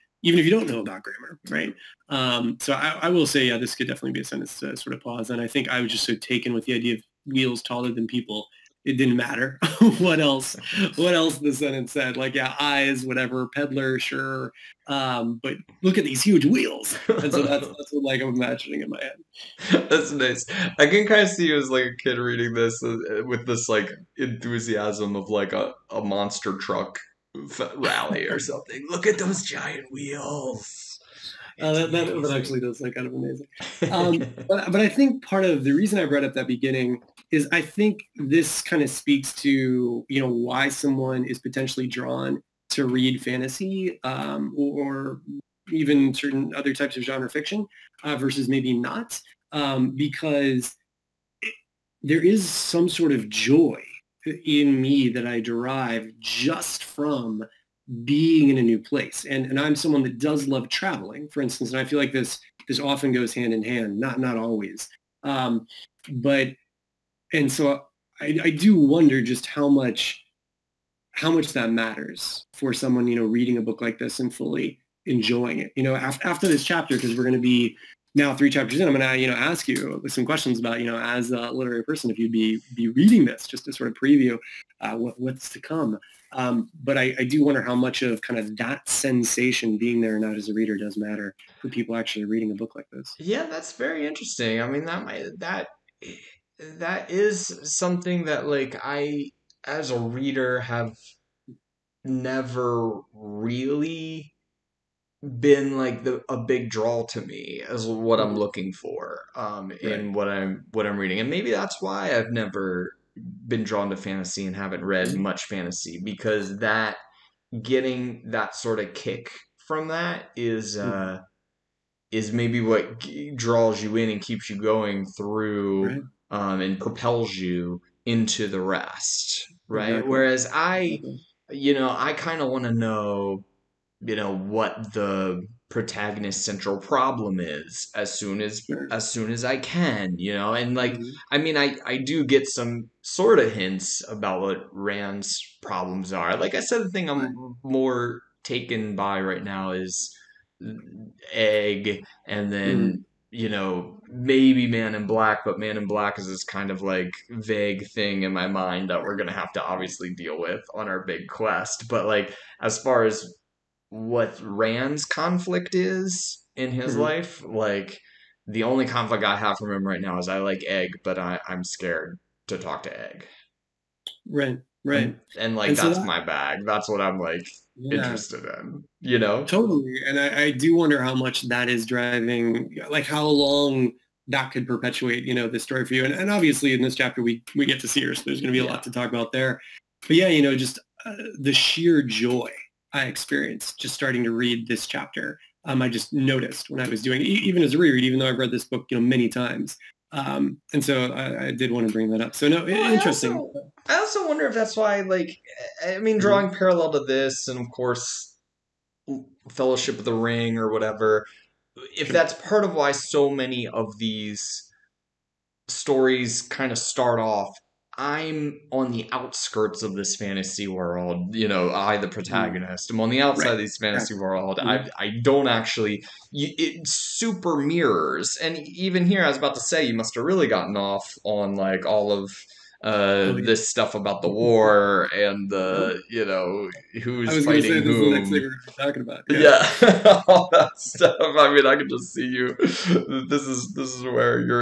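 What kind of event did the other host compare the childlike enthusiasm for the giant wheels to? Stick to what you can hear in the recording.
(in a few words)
monster truck rally.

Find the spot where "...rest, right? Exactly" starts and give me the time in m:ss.
2:08.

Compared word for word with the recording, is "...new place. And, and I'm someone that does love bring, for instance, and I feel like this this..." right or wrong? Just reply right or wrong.
wrong.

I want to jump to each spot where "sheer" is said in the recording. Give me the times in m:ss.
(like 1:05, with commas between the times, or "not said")
3:11.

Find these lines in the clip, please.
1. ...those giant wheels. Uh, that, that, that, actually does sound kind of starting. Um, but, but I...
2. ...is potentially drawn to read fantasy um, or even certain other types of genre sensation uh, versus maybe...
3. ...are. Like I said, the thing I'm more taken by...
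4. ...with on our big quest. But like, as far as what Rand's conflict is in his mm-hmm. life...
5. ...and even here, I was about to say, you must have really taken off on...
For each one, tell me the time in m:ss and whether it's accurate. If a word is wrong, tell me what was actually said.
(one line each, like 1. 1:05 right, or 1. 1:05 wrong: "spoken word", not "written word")
1. 0:29 wrong: "amazing", not "starting"
2. 0:41 wrong: "fiction", not "sensation"
3. 2:26 right
4. 2:40 right
5. 3:48 wrong: "gotten", not "taken".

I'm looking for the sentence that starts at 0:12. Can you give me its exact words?
Like yeah, eyes, whatever, peddler, sure.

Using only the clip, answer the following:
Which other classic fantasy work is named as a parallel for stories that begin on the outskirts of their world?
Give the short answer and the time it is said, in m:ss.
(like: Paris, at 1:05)
Fellowship of the Ring, at 3:29.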